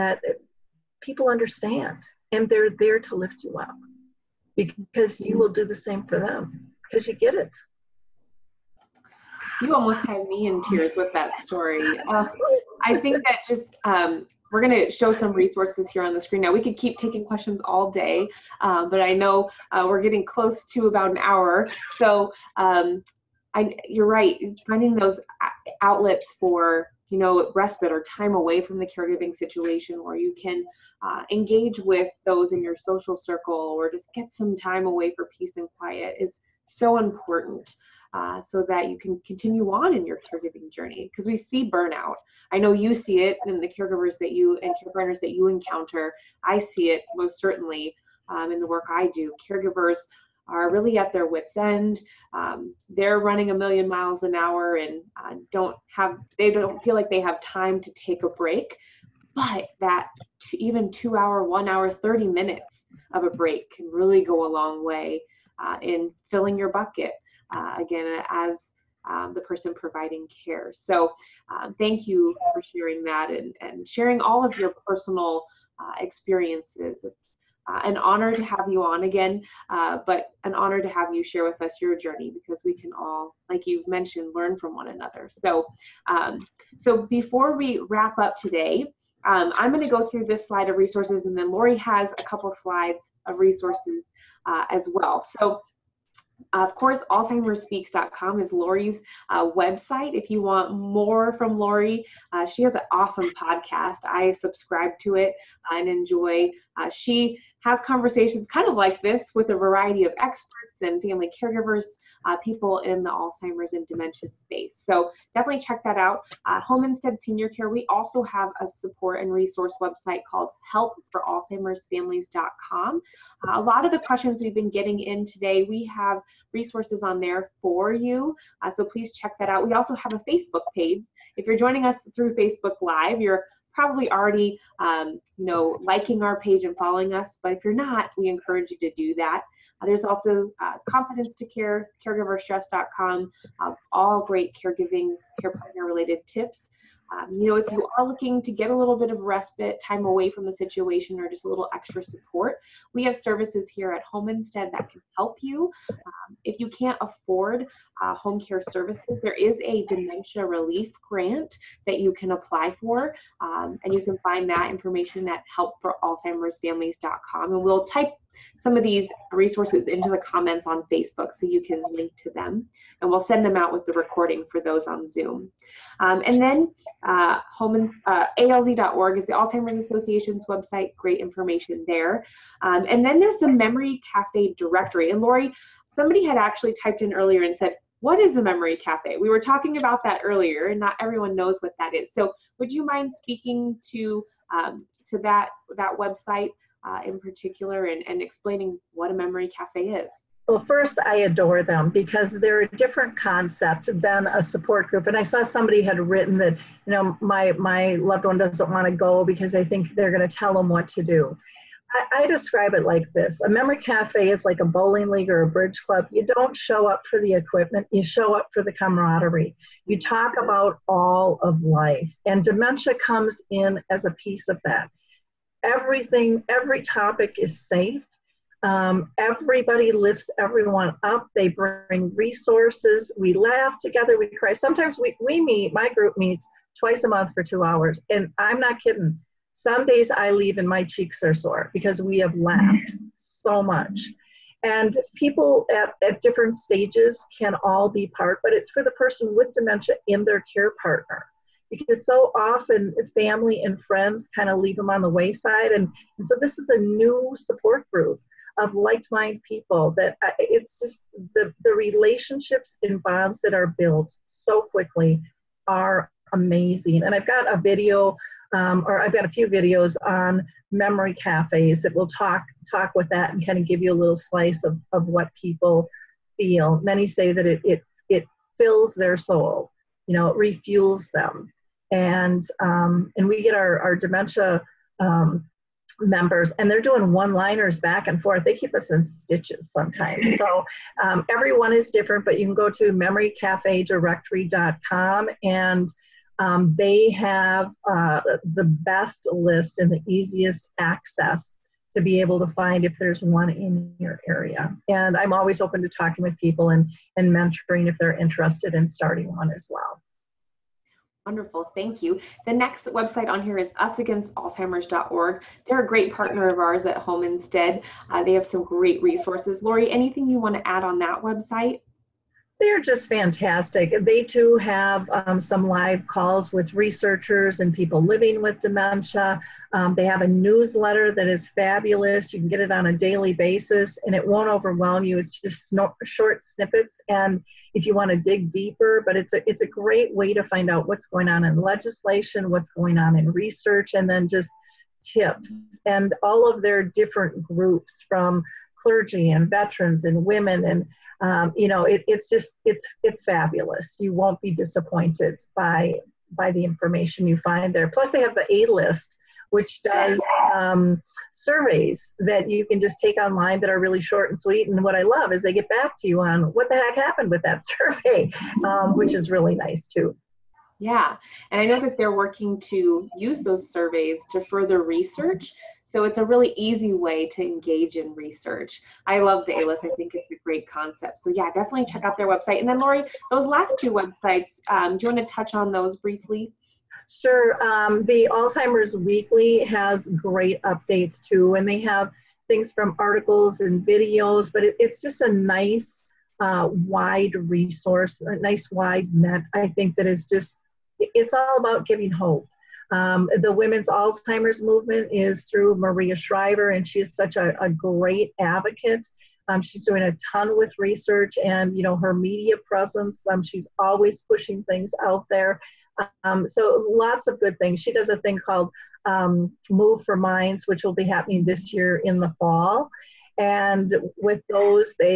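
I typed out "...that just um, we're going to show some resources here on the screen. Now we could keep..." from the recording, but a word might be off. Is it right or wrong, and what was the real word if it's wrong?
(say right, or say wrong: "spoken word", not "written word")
right.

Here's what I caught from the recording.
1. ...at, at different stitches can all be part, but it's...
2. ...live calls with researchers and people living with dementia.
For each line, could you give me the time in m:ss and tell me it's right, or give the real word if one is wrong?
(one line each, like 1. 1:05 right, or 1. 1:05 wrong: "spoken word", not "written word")
1. 4:05 wrong: "stages", not "stitches"
2. 5:25 right.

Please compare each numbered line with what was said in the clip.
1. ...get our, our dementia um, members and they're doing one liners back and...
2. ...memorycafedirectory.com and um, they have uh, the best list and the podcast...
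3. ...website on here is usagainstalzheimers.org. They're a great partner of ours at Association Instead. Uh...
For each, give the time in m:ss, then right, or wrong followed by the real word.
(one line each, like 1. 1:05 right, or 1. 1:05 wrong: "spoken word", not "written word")
1. 4:43 right
2. 4:52 wrong: "easiest", not "podcast"
3. 5:12 wrong: "Home", not "Association".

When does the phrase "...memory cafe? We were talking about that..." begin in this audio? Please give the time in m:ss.
3:08.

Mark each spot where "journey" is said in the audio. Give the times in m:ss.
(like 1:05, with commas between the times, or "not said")
0:40, 1:21.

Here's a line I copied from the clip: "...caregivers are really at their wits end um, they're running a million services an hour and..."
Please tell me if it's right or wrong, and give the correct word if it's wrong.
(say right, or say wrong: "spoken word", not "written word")
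wrong: "miles", not "services".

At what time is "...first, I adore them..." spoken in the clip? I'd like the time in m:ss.
3:20.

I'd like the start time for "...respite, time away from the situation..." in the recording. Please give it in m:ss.
2:29.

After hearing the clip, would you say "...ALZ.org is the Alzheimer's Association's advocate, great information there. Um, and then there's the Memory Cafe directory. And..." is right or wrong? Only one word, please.
wrong.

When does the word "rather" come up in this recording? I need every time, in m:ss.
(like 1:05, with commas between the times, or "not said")
not said.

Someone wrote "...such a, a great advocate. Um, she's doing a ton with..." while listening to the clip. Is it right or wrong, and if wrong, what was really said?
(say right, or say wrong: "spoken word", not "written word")
right.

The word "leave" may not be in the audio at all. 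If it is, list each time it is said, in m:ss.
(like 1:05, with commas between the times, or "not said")
4:00, 4:14.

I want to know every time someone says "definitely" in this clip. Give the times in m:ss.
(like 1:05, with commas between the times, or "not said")
1:55, 6:21.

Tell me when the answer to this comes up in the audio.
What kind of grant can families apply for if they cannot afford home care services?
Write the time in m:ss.
2:39.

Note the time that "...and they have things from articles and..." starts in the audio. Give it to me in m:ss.
6:31.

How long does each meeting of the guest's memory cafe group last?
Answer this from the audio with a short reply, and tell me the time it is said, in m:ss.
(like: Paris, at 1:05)
2 hours, at 3:57.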